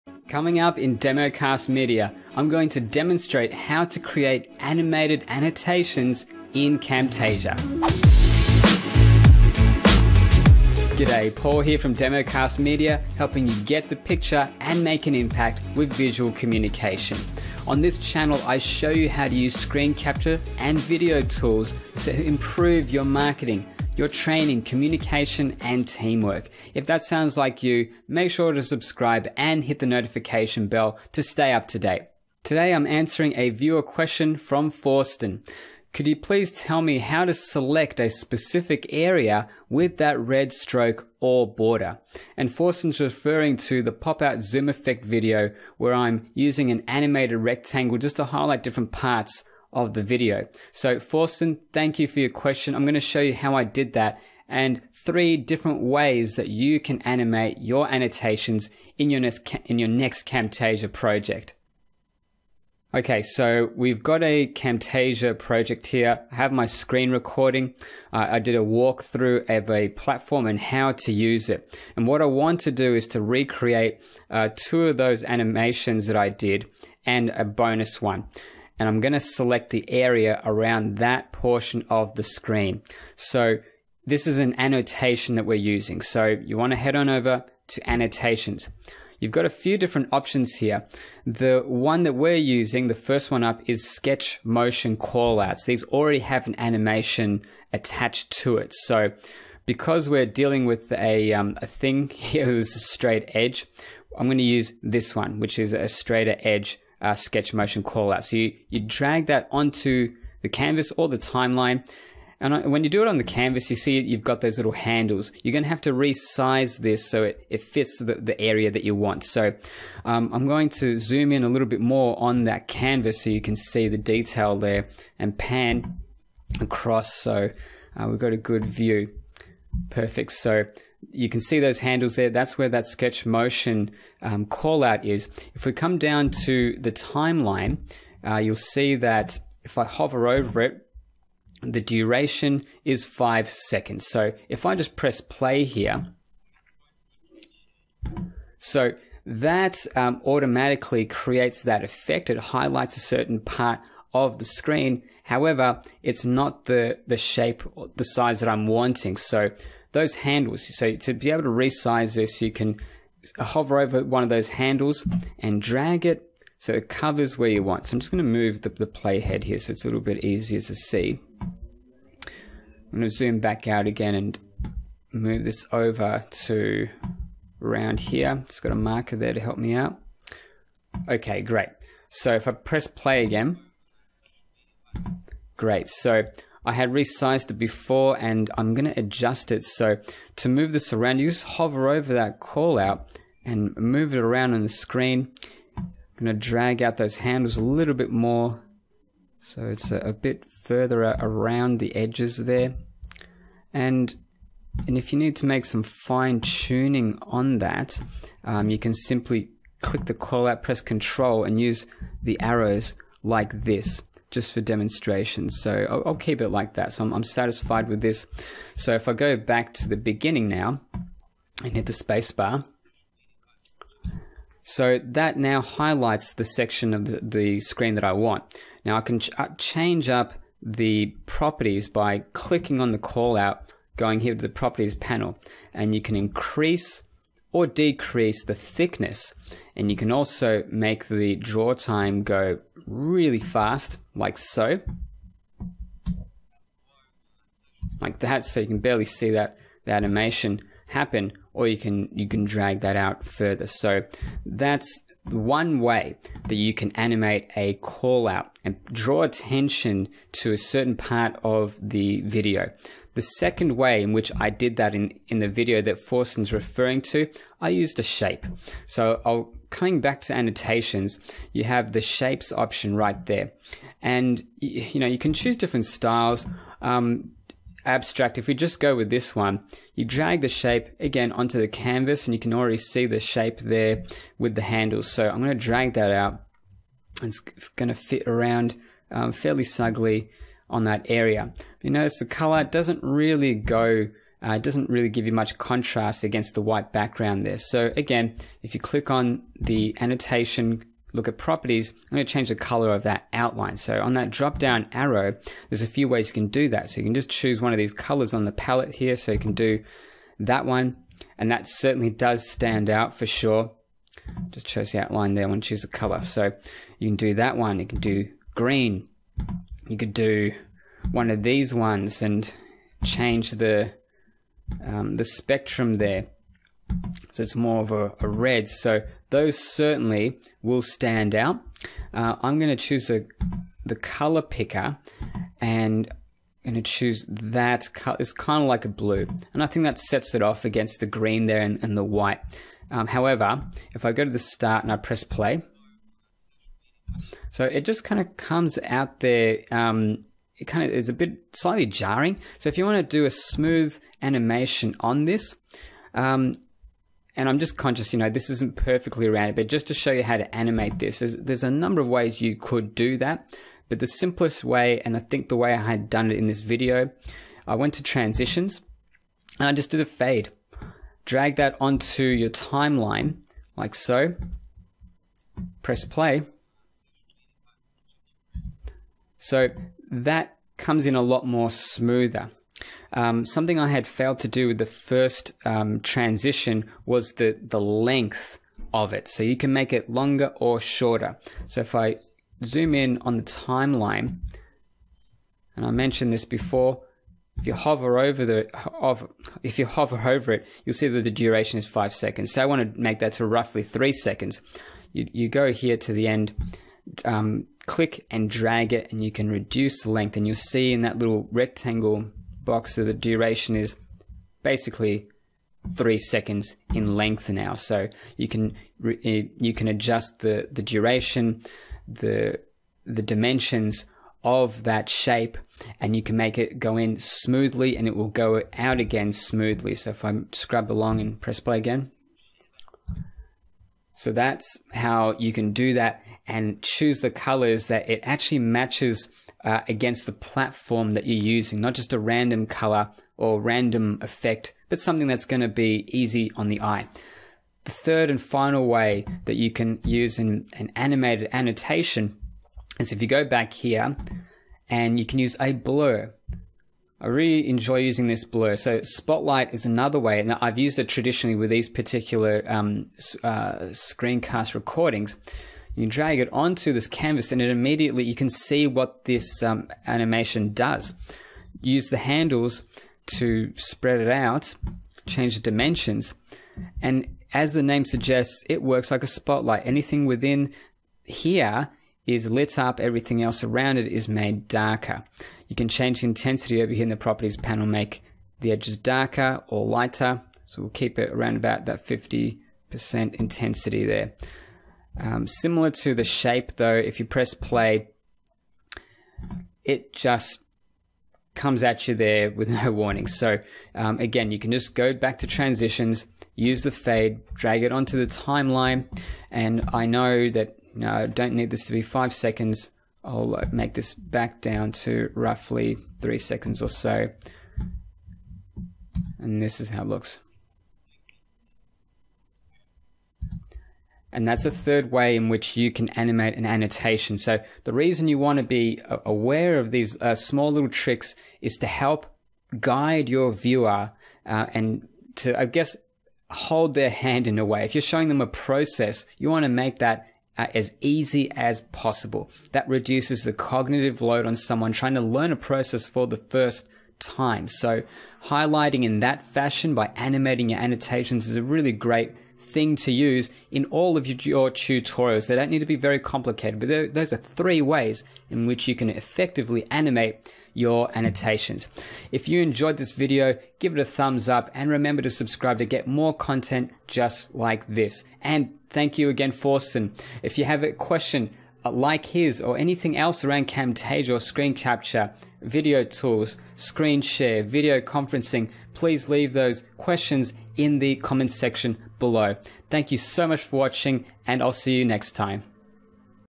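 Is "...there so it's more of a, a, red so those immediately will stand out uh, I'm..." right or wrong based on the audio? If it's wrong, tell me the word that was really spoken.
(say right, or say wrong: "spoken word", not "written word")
wrong: "certainly", not "immediately".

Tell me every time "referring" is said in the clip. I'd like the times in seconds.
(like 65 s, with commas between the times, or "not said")
43 s, 266 s.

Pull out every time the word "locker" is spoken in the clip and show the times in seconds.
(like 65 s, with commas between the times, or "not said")
not said.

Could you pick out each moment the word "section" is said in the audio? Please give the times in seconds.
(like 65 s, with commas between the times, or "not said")
226 s, 581 s.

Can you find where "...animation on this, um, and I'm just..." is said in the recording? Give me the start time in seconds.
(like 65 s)
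354 s.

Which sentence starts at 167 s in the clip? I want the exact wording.
So I'm just going to move the, the playhead here so it's a little bit easier to see.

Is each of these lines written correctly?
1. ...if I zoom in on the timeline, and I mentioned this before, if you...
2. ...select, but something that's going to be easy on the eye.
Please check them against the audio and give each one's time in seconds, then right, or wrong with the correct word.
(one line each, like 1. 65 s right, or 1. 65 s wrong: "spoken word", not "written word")
1. 391 s right
2. 444 s wrong: "effect", not "select".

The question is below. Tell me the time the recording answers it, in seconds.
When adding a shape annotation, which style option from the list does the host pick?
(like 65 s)
277 s.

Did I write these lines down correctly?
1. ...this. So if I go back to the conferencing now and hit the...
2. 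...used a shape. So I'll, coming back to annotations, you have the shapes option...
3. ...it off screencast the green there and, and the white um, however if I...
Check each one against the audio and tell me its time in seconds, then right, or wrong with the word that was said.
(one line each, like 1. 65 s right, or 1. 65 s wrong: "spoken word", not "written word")
1. 218 s wrong: "beginning", not "conferencing"
2. 267 s right
3. 340 s wrong: "against", not "screencast".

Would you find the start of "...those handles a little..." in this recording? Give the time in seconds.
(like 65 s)
196 s.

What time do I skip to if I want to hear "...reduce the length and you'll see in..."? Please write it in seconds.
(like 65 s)
409 s.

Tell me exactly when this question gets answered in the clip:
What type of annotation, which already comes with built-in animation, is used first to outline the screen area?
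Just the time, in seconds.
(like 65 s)
93 s.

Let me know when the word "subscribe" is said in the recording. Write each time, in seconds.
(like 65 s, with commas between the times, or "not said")
28 s, 565 s.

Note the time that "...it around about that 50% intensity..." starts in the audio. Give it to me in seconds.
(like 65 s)
491 s.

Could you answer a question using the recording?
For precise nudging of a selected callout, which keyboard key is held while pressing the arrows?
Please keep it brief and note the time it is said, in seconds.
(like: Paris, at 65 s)
Control, at 210 s.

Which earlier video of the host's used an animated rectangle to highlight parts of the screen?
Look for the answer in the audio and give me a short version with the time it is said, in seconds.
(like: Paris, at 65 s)
pop-out zoom effect, at 43 s.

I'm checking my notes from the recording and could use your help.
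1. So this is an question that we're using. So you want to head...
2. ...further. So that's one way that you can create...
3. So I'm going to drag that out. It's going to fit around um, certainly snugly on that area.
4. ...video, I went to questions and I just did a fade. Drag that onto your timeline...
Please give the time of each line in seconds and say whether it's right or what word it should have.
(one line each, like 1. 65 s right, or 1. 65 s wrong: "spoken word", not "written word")
1. 83 s wrong: "annotation", not "question"
2. 253 s wrong: "animate", not "create"
3. 285 s wrong: "fairly", not "certainly"
4. 366 s wrong: "transitions", not "questions".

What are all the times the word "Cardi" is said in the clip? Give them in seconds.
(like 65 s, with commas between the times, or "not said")
not said.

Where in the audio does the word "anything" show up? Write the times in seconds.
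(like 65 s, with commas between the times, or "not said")
479 s, 572 s.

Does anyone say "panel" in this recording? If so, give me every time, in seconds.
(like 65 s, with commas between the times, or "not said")
234 s, 487 s.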